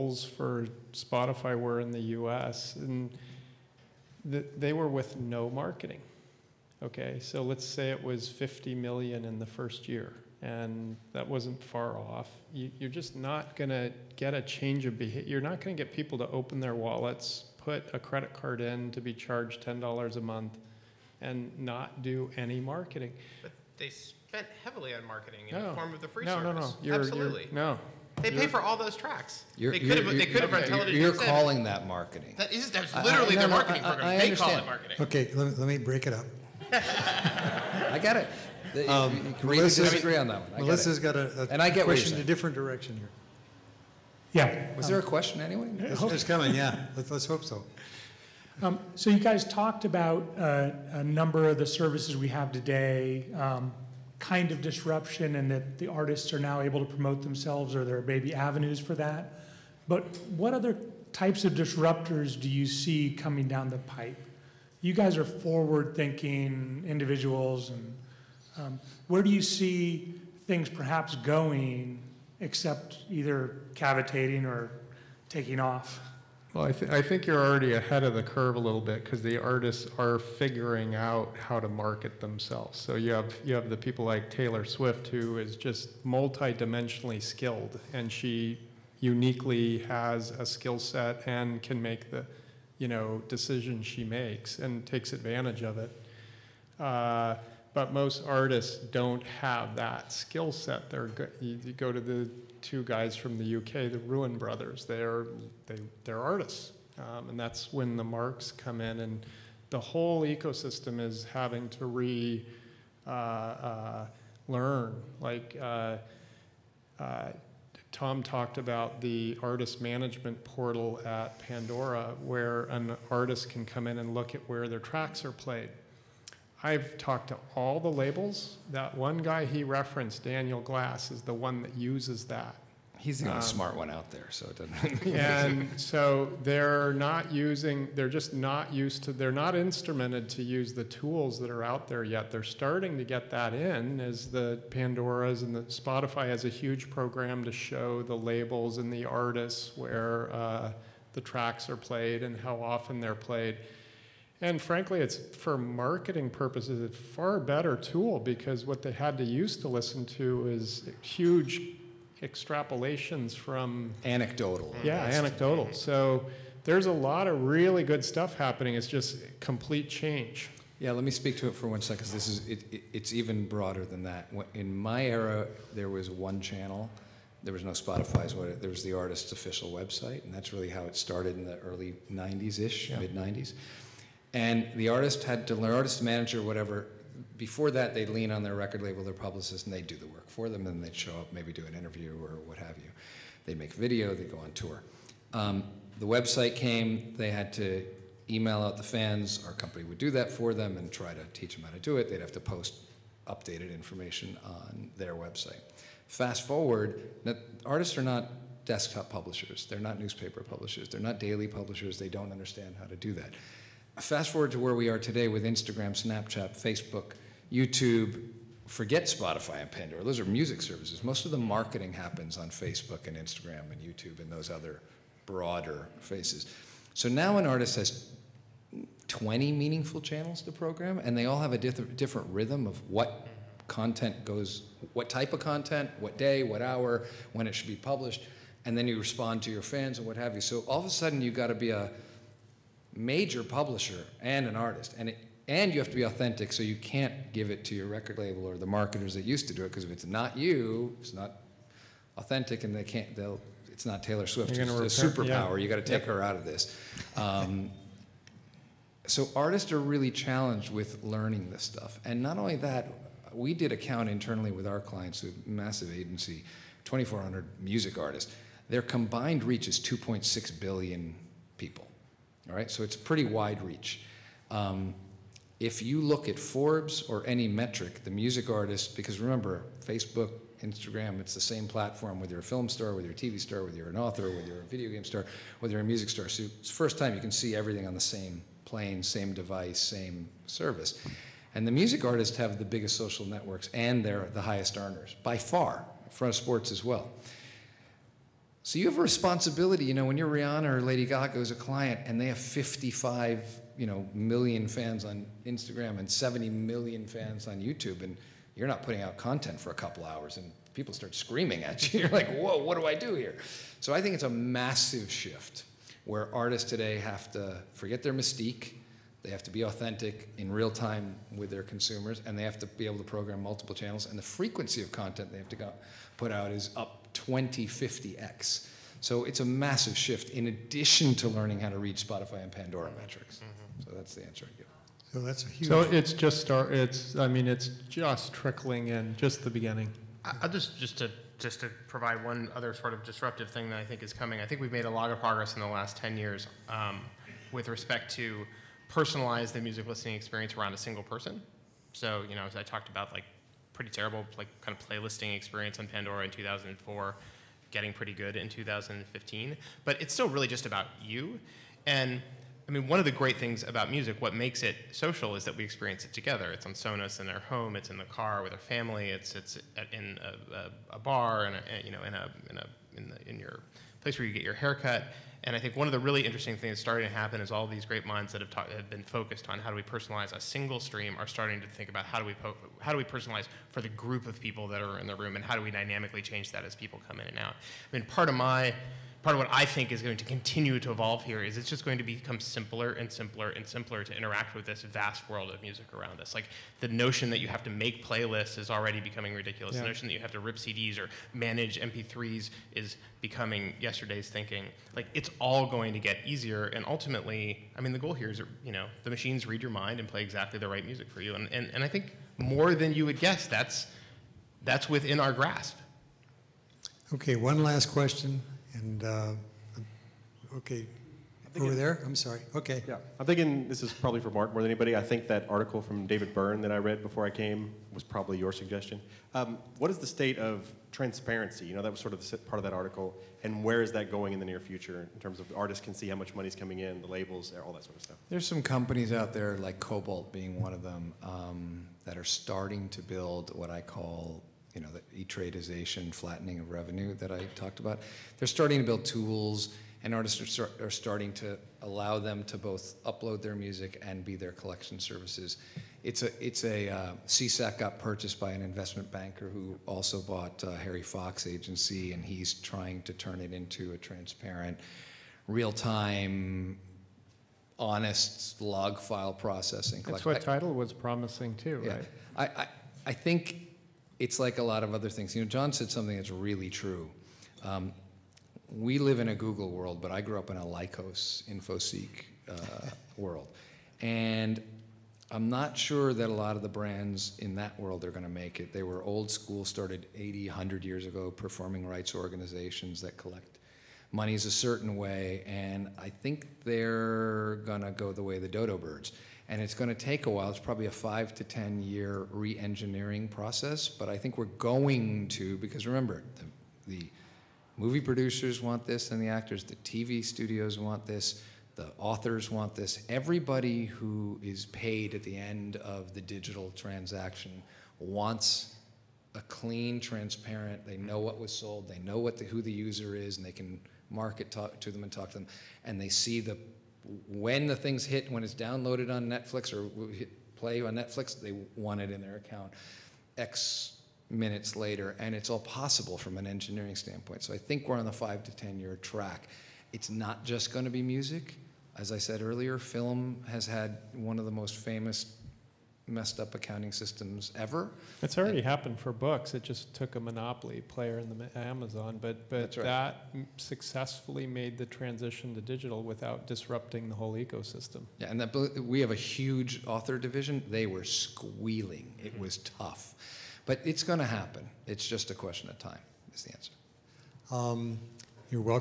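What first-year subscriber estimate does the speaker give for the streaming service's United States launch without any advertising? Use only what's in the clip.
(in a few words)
50 million.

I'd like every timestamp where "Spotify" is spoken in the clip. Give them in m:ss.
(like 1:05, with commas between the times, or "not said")
0:00, 2:25, 2:57, 3:39, 5:31.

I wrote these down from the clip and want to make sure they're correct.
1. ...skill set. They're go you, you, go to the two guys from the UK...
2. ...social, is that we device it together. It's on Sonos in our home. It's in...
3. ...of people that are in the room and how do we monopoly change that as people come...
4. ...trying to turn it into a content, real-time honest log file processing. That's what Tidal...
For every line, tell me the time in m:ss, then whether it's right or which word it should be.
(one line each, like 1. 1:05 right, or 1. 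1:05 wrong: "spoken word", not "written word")
1. 1:40 right
2. 6:04 wrong: "experience", not "device"
3. 6:24 wrong: "dynamically", not "monopoly"
4. 7:42 wrong: "transparent", not "content".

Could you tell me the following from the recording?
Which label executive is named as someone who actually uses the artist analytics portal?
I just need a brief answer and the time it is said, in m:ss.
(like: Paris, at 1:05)
Daniel Glass, at 2:10.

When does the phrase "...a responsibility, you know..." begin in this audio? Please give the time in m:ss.
4:58.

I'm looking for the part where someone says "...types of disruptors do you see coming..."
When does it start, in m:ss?
1:01.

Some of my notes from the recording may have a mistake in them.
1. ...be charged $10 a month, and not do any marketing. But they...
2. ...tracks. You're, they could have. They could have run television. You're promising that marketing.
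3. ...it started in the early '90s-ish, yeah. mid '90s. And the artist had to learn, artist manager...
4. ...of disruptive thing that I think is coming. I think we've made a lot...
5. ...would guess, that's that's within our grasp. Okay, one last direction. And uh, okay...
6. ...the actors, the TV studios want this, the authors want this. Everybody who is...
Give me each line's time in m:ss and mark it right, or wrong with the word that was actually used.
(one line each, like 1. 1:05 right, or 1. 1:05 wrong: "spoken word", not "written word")
1. 0:18 right
2. 0:28 wrong: "calling", not "promising"
3. 3:00 right
4. 5:42 right
5. 6:53 wrong: "question", not "direction"
6. 8:29 right.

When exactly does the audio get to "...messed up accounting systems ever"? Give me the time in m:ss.
9:06.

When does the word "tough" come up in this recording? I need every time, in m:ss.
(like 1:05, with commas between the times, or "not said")
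9:22.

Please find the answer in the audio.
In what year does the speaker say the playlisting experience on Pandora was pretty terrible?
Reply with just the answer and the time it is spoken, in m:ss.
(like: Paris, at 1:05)
2004, at 5:56.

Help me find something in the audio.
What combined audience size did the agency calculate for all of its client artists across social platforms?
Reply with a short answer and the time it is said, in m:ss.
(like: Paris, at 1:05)
2.6 billion, at 4:29.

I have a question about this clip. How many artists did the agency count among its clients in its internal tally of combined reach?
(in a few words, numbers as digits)
2,400.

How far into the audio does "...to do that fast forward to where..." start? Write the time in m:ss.
3:32.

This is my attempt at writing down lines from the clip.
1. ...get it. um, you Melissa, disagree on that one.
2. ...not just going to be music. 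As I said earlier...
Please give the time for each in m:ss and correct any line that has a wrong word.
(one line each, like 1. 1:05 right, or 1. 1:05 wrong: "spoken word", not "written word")
1. 0:38 right
2. 9:00 right.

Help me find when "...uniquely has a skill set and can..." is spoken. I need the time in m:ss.
1:28.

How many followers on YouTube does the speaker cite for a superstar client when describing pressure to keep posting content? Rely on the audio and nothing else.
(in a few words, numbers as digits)
70 million.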